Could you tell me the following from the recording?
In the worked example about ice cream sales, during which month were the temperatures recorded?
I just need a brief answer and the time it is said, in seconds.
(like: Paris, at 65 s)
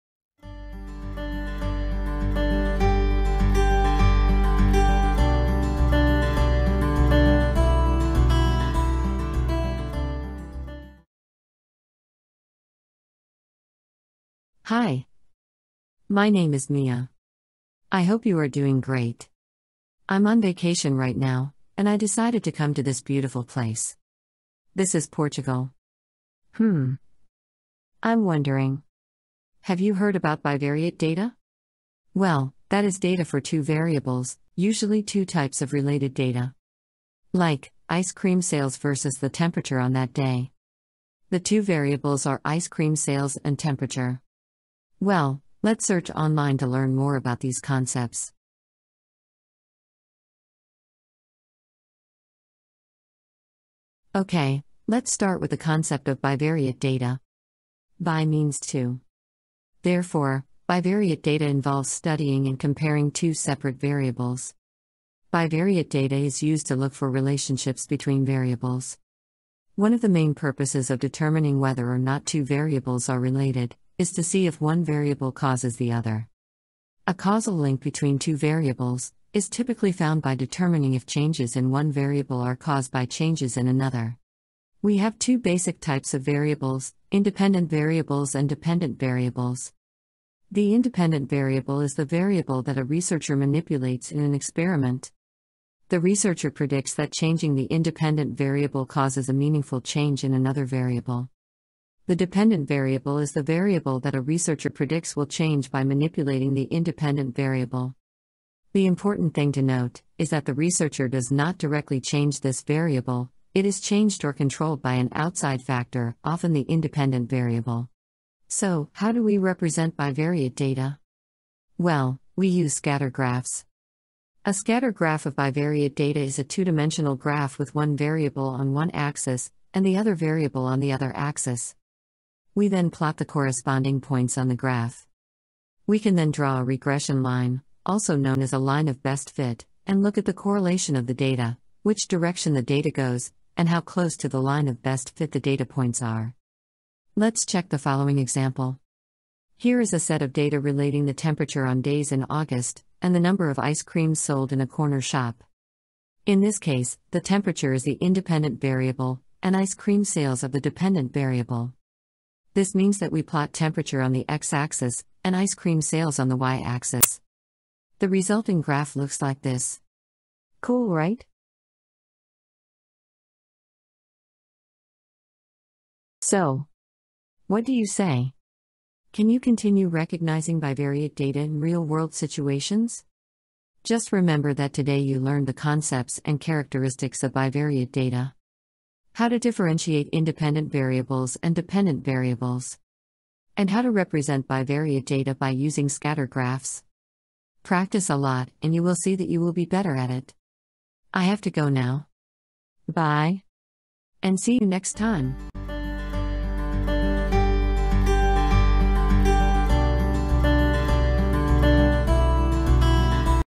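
August, at 152 s.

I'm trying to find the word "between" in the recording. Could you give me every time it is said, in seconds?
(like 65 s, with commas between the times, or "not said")
67 s, 77 s.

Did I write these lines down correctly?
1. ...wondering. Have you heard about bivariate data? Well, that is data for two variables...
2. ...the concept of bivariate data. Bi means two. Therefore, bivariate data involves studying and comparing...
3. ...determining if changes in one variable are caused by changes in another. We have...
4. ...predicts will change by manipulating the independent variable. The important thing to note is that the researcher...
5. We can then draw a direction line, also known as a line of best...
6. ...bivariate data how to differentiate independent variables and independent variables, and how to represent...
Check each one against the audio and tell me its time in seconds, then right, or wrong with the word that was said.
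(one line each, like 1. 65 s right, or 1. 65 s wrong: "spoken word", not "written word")
1. 28 s right
2. 55 s right
3. 80 s right
4. 104 s right
5. 135 s wrong: "regression", not "direction"
6. 187 s wrong: "dependent", not "independent".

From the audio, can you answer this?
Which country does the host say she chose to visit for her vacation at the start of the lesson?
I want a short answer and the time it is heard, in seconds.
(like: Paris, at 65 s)
Portugal, at 25 s.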